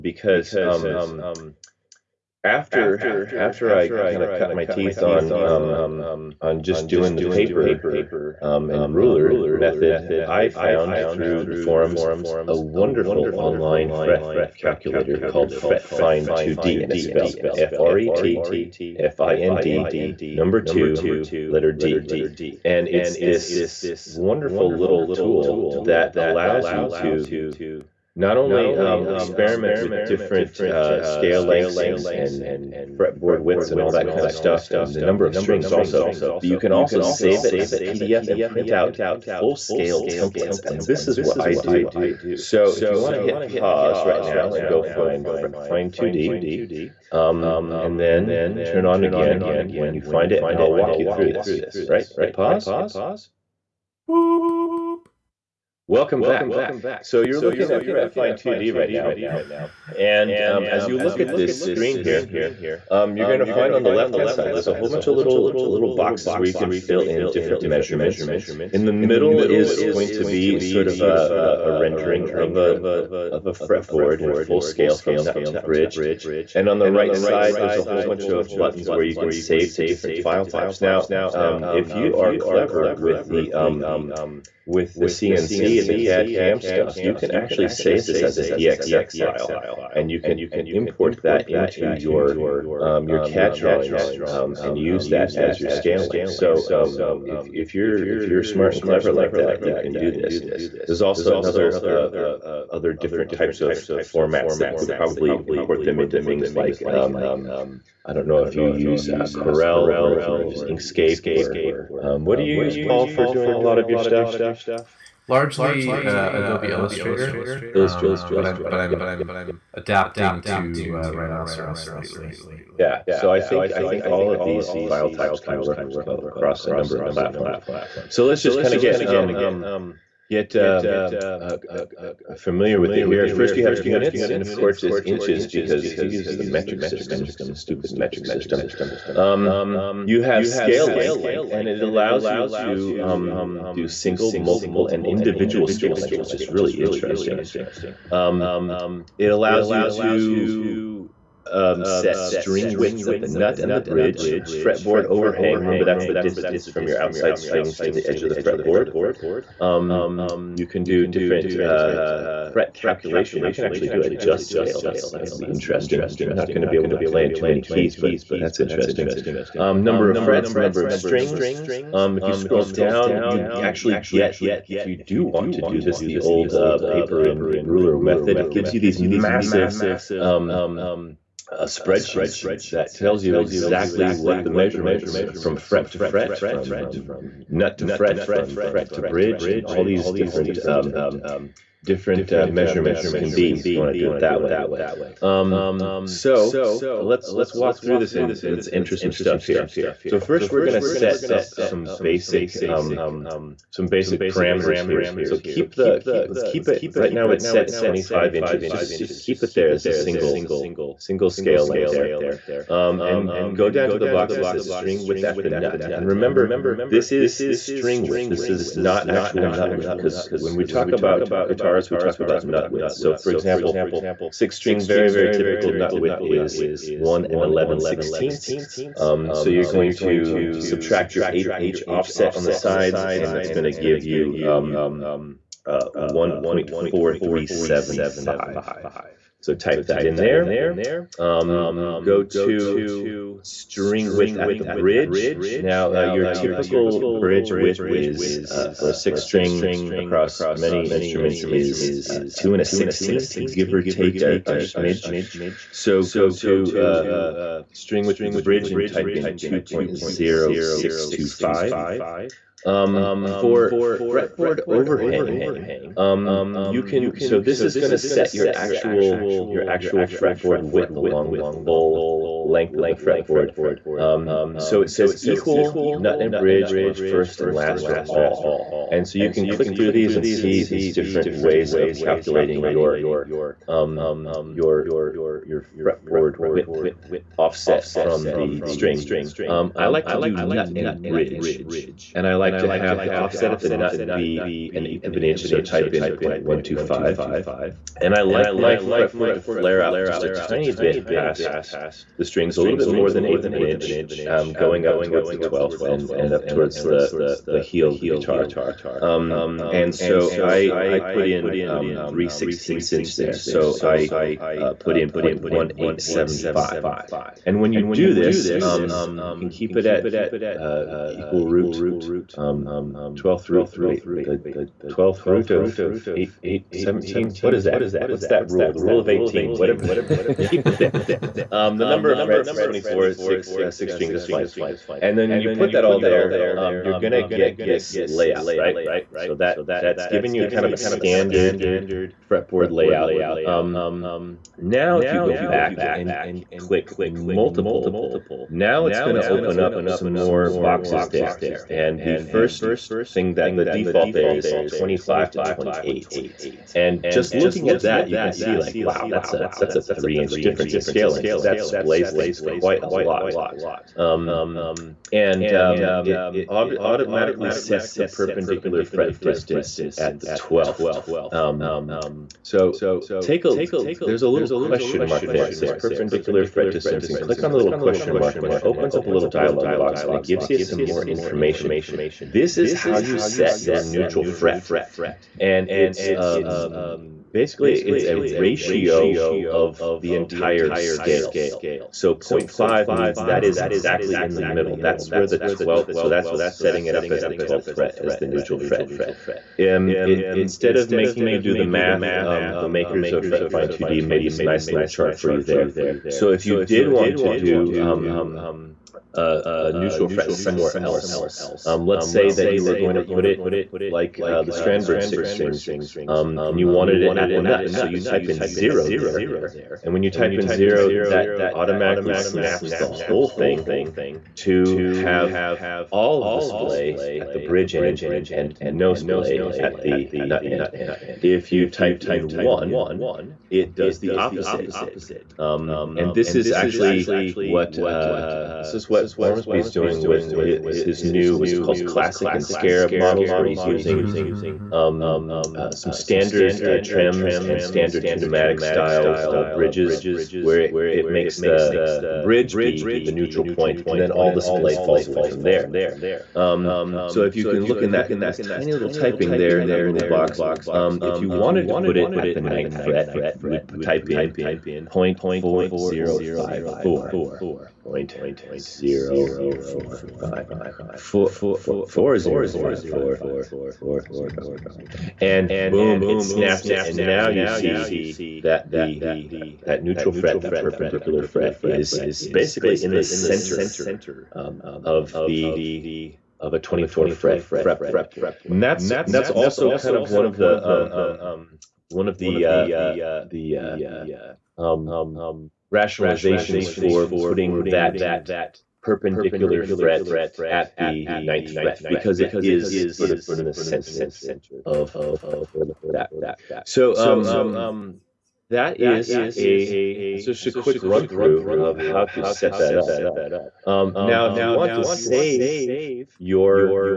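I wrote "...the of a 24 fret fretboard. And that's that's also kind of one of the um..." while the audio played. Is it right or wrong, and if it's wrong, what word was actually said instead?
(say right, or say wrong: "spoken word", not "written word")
right.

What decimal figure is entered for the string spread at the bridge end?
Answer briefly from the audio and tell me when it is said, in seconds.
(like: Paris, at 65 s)
2.0625, at 259 s.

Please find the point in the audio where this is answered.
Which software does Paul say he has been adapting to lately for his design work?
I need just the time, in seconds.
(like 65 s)
121 s.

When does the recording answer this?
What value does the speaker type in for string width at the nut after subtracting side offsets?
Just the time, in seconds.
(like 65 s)
235 s.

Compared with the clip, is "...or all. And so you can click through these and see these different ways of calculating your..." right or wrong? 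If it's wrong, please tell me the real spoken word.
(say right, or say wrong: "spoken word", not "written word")
right.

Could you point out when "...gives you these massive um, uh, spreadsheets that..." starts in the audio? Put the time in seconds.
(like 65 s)
178 s.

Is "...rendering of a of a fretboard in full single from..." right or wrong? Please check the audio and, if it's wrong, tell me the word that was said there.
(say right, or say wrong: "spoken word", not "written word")
wrong: "scale", not "single".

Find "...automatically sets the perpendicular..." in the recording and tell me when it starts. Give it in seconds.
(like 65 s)
366 s.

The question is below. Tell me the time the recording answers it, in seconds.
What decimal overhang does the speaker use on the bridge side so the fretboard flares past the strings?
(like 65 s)
315 s.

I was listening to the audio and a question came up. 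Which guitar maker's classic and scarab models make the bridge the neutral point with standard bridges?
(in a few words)
Ormsby.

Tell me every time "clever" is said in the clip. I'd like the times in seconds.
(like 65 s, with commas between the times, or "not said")
82 s, 98 s.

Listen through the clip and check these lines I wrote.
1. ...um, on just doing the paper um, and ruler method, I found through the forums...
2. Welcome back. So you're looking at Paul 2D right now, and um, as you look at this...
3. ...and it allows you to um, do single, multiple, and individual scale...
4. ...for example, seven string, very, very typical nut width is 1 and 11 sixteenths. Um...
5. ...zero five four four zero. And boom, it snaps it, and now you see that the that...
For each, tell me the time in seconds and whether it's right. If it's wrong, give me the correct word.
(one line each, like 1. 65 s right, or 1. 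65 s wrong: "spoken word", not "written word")
1. 5 s right
2. 55 s wrong: "FretFind", not "Paul"
3. 141 s right
4. 223 s wrong: "six", not "seven"
5. 472 s right.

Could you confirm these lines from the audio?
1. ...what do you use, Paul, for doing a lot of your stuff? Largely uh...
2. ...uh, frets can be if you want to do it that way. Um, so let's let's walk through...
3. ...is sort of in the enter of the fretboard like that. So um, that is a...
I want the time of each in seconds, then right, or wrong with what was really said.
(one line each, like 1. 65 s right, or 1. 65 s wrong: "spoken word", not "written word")
1. 112 s right
2. 192 s wrong: "measurements", not "frets"
3. 502 s wrong: "center", not "enter".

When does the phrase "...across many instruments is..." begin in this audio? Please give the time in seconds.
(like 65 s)
249 s.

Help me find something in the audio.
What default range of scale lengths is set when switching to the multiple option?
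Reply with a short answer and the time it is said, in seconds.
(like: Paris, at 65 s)
25 to 28, at 354 s.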